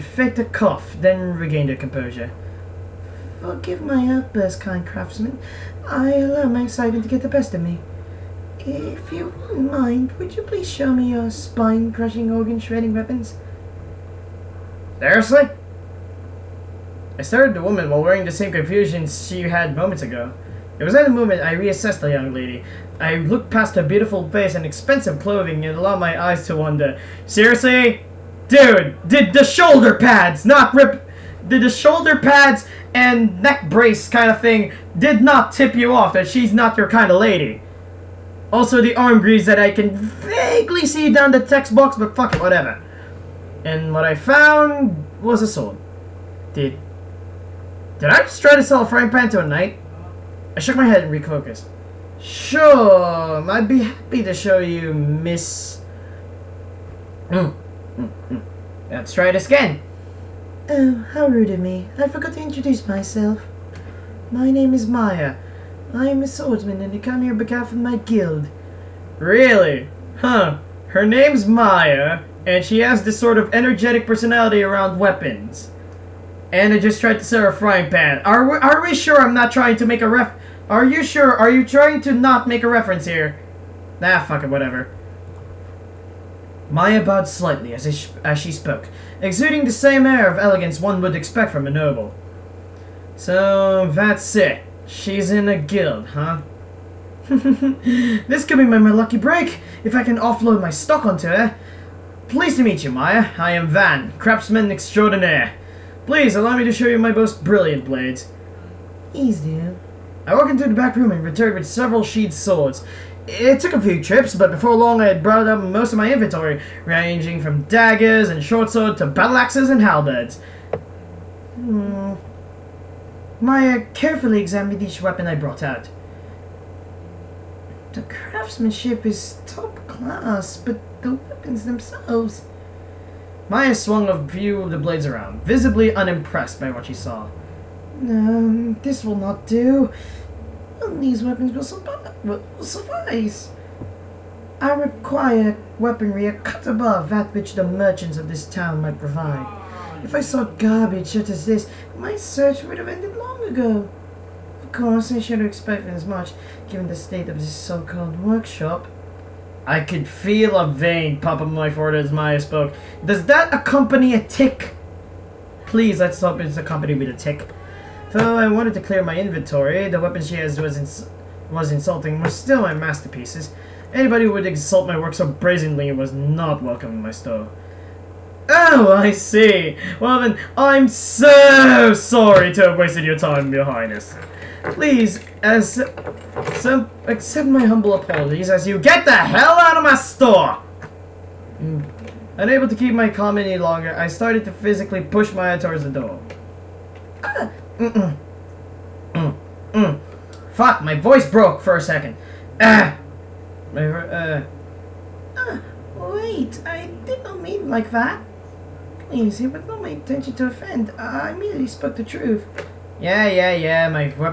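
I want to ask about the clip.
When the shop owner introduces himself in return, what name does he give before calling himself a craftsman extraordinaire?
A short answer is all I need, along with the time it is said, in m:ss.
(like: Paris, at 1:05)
Van, at 1:43.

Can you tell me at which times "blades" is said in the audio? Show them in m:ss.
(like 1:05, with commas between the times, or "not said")
1:47, 2:14.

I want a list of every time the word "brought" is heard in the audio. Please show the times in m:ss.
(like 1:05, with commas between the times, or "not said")
1:55, 2:05.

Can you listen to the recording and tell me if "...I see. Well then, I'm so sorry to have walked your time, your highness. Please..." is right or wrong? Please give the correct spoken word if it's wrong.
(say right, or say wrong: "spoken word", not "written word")
wrong: "wasted", not "walked".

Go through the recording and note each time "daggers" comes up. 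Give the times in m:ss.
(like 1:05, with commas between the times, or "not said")
1:57.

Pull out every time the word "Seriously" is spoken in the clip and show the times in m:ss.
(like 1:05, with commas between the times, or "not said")
0:14, 0:27.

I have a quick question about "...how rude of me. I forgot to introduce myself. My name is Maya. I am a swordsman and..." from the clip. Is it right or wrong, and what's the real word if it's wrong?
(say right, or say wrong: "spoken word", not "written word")
right.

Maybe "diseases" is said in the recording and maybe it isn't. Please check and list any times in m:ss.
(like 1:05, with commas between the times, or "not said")
not said.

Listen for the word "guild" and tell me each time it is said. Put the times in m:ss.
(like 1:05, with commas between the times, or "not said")
1:08, 1:35.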